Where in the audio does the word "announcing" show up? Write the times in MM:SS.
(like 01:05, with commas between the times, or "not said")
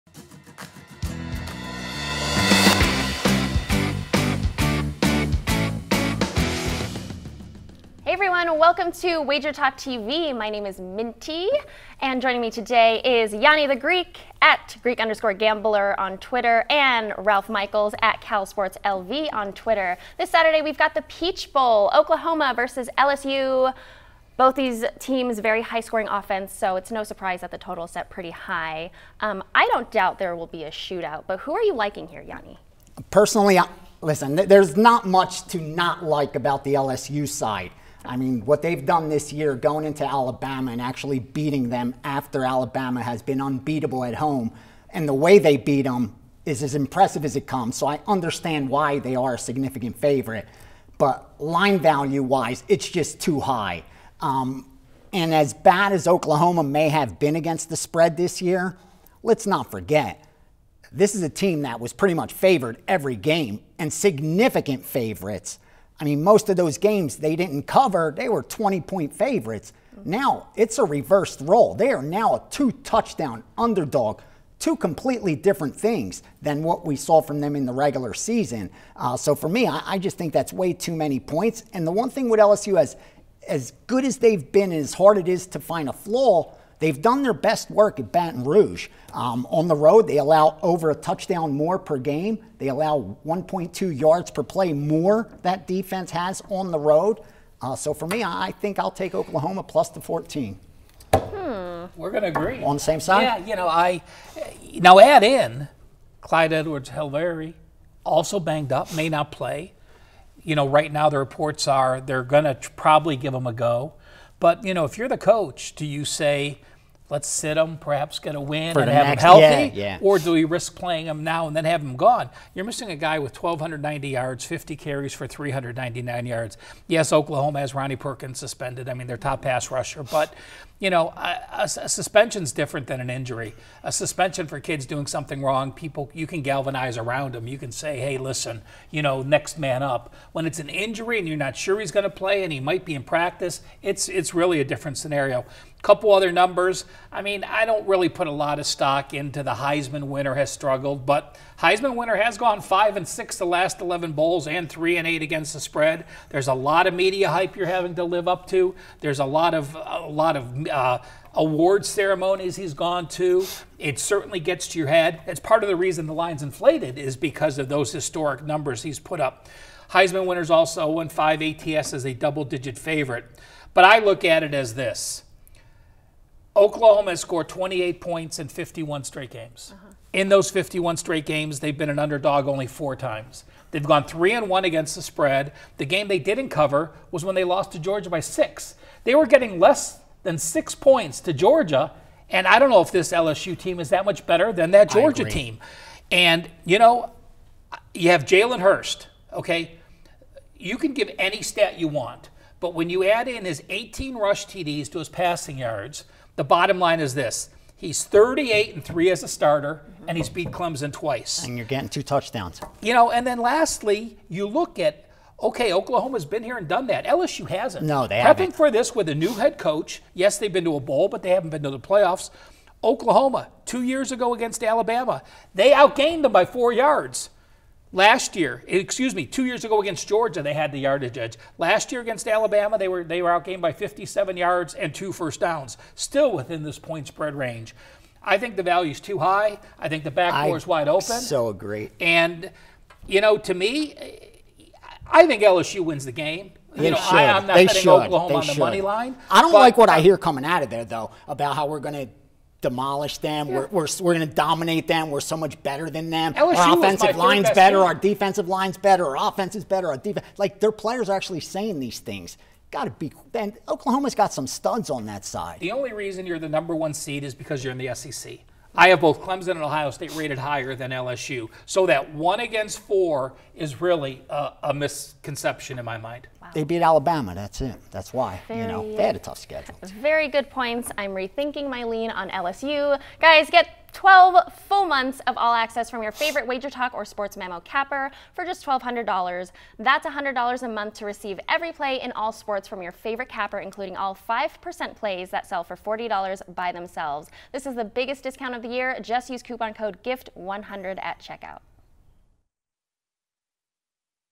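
not said.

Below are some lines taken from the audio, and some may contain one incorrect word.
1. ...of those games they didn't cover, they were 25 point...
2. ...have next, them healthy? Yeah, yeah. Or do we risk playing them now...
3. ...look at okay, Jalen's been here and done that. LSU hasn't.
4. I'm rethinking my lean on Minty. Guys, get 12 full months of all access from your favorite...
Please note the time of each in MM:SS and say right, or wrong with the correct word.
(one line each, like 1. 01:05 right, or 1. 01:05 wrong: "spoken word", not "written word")
1. 01:06 wrong: "20", not "25"
2. 01:58 right
3. 03:34 wrong: "Oklahoma", not "Jalen"
4. 04:40 wrong: "LSU", not "Minty".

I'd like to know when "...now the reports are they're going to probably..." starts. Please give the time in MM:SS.
01:50.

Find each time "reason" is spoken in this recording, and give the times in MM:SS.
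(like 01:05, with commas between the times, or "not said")
02:45, 04:25.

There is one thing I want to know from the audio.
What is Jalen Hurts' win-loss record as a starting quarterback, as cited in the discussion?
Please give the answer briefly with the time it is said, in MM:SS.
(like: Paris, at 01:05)
38 and 3, at 03:28.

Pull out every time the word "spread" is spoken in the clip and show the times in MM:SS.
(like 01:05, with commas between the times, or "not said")
00:57, 02:35, 03:05, 03:57.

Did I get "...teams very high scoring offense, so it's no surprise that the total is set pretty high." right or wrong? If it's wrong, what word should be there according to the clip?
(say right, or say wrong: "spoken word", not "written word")
right.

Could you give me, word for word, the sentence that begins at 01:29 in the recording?
Um, on the road, they allow over a touchdown more per game.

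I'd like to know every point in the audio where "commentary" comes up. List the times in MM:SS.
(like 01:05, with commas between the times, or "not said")
not said.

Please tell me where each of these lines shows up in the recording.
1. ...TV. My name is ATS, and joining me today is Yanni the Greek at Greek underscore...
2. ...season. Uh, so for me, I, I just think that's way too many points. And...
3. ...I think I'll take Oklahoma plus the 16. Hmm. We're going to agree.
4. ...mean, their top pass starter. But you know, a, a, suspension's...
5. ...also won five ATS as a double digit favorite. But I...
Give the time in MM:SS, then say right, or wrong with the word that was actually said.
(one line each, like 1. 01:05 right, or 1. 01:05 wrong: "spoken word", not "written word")
1. 00:09 wrong: "Minty", not "ATS"
2. 01:18 right
3. 01:38 wrong: "14", not "16"
4. 02:08 wrong: "rusher", not "starter"
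5. 02:50 right.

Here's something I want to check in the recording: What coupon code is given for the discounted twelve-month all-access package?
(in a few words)
GIFT100.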